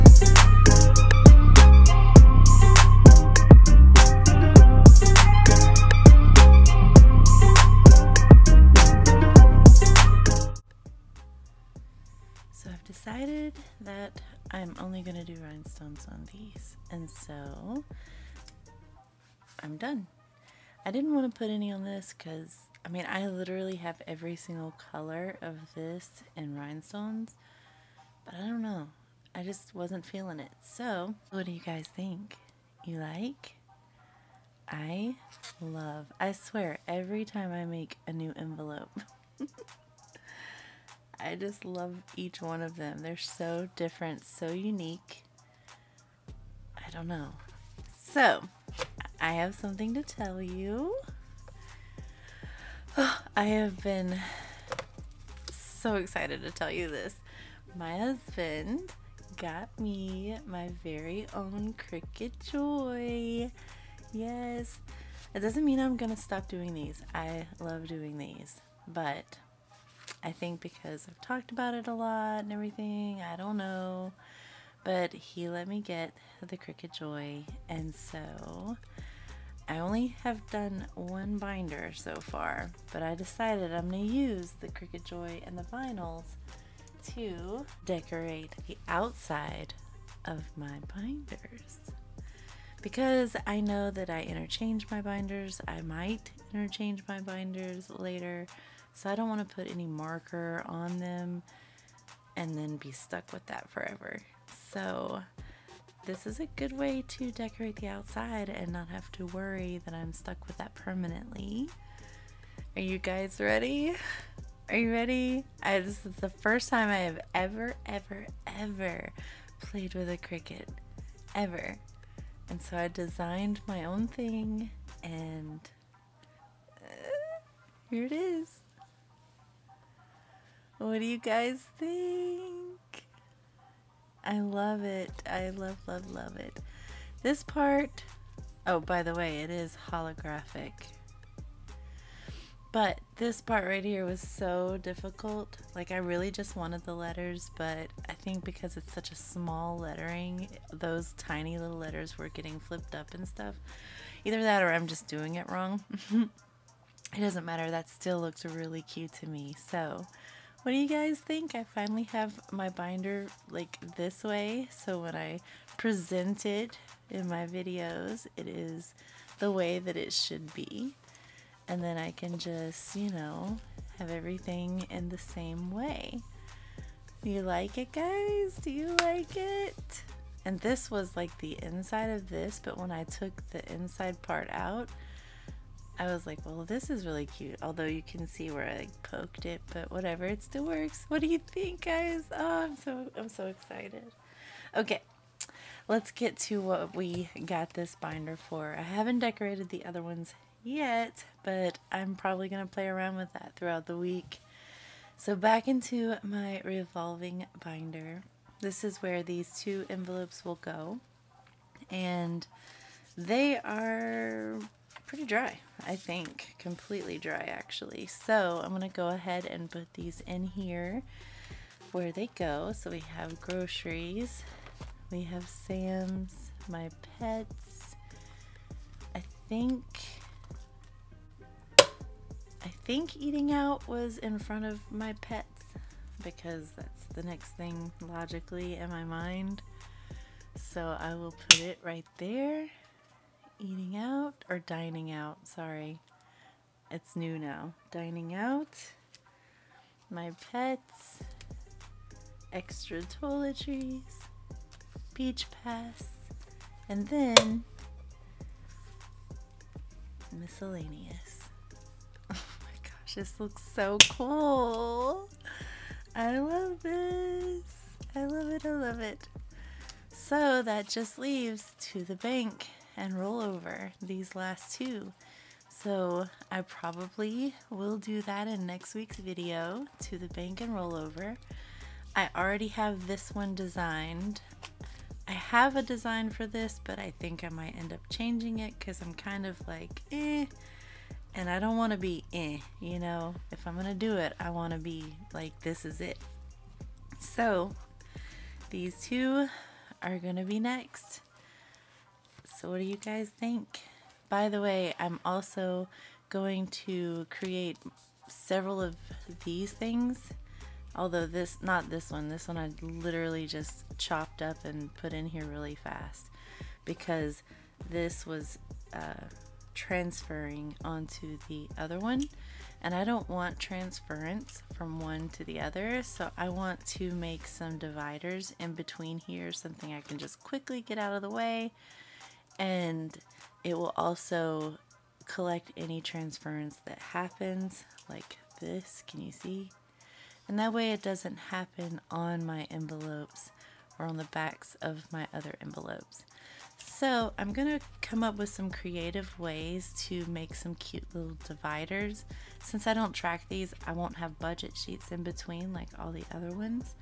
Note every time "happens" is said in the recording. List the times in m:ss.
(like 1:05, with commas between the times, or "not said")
5:36, 5:41.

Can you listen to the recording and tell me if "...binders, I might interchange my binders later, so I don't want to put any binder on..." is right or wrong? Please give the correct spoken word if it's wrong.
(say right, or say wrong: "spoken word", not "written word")
wrong: "marker", not "binder".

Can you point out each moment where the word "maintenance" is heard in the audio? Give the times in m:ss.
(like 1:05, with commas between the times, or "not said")
not said.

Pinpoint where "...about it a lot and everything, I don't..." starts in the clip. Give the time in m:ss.
1:11.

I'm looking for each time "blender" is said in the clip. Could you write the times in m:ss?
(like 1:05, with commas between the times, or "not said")
not said.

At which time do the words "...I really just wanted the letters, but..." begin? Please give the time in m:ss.
2:25.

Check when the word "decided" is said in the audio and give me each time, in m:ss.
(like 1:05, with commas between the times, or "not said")
0:13, 1:23.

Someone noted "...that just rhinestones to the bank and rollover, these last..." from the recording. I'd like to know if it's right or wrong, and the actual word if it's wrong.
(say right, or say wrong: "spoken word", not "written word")
wrong: "leaves", not "rhinestones".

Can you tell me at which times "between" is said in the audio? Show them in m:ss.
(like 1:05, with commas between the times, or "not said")
5:28, 5:55.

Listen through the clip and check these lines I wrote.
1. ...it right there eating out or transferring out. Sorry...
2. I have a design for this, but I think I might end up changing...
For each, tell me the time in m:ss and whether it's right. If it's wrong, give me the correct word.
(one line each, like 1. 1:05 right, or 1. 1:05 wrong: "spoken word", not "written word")
1. 4:01 wrong: "dining", not "transferring"
2. 4:45 right.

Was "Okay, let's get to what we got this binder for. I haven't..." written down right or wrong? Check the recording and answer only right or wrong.
right.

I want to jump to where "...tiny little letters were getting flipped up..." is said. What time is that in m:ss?
2:31.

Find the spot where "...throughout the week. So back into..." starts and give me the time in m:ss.
3:23.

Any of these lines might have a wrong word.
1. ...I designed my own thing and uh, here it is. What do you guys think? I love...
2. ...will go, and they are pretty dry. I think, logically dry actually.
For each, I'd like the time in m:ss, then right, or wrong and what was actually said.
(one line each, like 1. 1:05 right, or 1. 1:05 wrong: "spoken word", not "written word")
1. 2:02 right
2. 3:30 wrong: "completely", not "logically".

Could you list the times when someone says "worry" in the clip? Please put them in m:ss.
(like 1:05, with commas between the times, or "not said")
1:49.